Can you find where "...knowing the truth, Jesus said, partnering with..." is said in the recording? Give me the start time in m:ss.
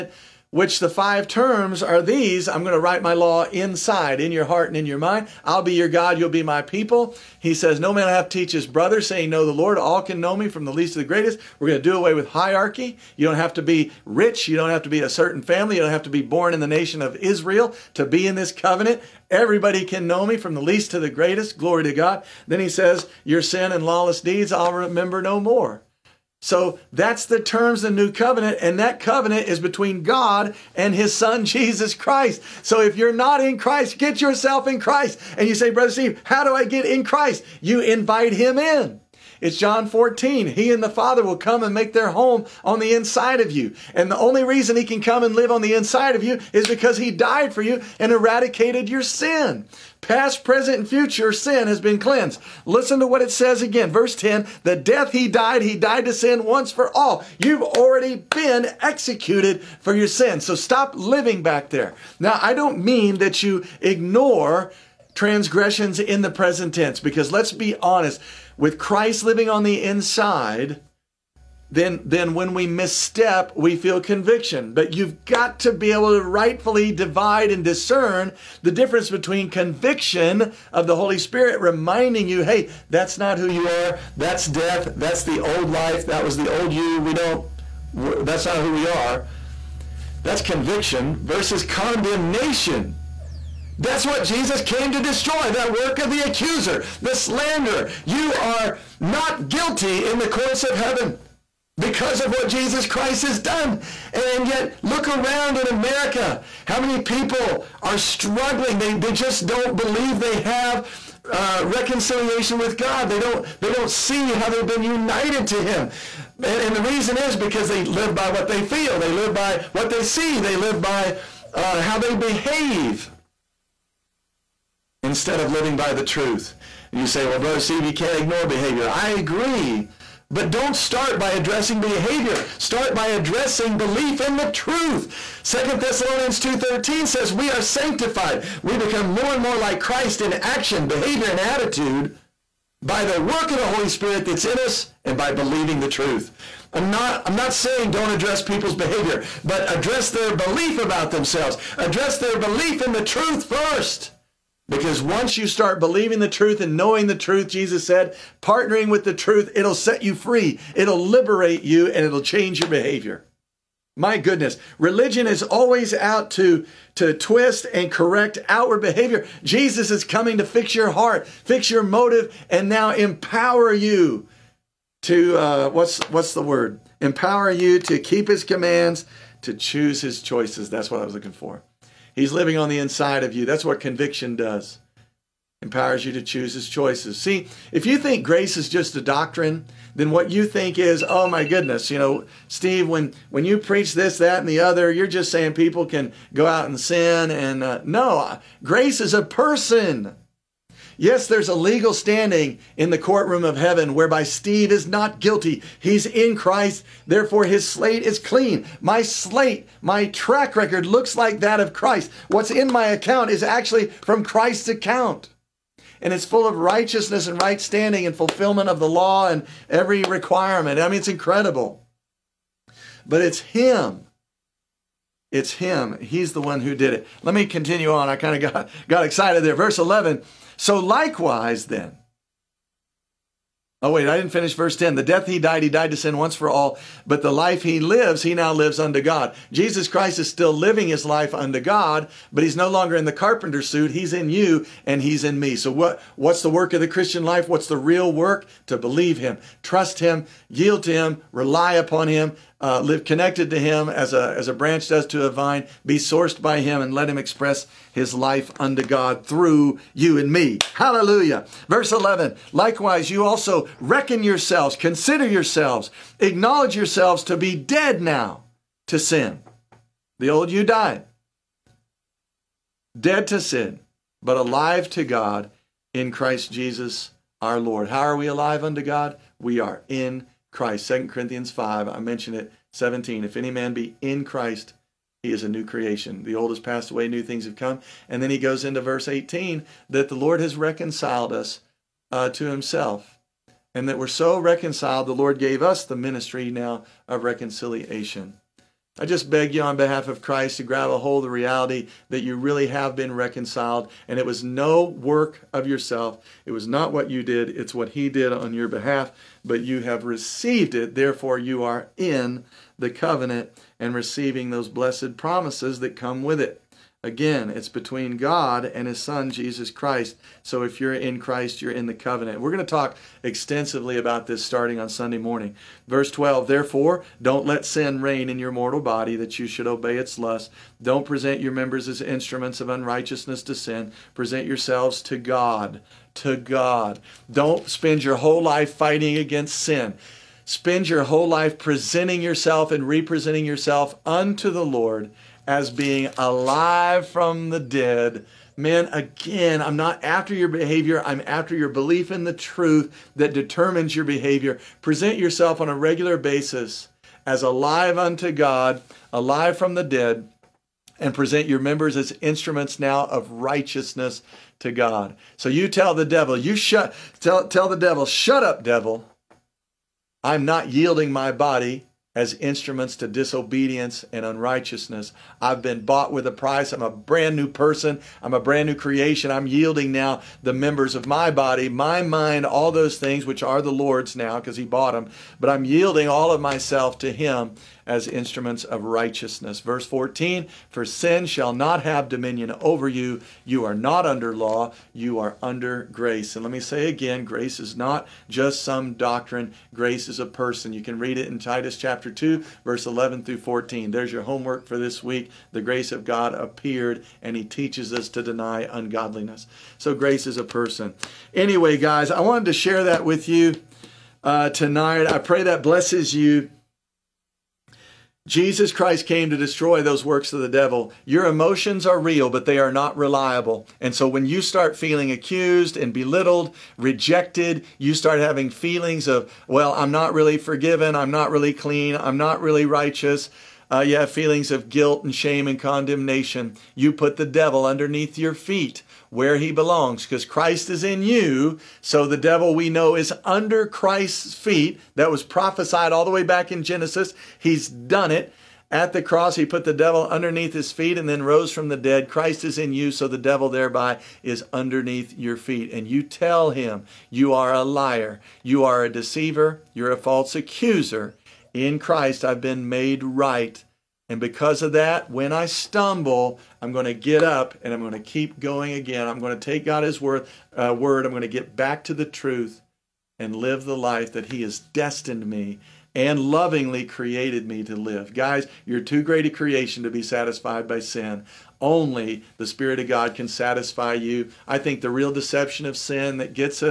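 2:36.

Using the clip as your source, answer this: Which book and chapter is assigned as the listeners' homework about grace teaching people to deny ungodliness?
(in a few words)
Titus chapter 2.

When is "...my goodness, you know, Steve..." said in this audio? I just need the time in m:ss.
3:11.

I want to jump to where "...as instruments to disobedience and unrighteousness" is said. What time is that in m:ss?
6:12.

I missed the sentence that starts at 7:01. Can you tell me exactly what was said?
Your emotions are real, but they are not reliable.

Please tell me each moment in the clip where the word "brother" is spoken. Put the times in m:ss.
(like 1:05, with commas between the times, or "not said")
0:08, 0:35, 2:07.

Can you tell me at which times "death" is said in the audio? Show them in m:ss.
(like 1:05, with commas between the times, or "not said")
0:54, 1:24, 3:55.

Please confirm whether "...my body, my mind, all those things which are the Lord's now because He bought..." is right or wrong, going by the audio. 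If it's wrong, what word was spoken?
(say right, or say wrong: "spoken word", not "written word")
right.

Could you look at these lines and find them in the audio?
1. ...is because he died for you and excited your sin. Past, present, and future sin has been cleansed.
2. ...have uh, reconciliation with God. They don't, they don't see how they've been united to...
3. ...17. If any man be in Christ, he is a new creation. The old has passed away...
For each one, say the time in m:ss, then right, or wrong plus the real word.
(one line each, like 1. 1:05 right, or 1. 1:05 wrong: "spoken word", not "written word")
1. 0:46 wrong: "eradicated", not "excited"
2. 1:50 right
3. 4:42 right.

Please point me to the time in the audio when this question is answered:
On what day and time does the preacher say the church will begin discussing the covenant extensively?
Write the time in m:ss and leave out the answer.
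5:24.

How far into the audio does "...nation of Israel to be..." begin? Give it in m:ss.
0:16.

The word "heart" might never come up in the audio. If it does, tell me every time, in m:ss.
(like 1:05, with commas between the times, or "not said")
0:04, 2:50.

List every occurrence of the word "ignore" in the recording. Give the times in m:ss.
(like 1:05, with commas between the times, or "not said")
1:03, 2:08.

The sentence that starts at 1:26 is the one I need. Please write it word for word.
We don't, that's not who we are.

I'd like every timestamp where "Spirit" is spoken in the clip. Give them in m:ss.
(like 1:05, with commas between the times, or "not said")
1:21, 2:23, 8:02.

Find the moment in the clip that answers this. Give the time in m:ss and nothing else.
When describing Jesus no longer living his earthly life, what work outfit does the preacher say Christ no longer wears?
4:03.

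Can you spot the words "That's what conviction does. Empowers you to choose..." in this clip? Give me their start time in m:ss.
3:03.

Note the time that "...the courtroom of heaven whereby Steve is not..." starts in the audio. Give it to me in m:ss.
3:22.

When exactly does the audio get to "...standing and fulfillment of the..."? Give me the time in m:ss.
3:37.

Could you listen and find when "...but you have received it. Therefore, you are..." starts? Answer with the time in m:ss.
5:09.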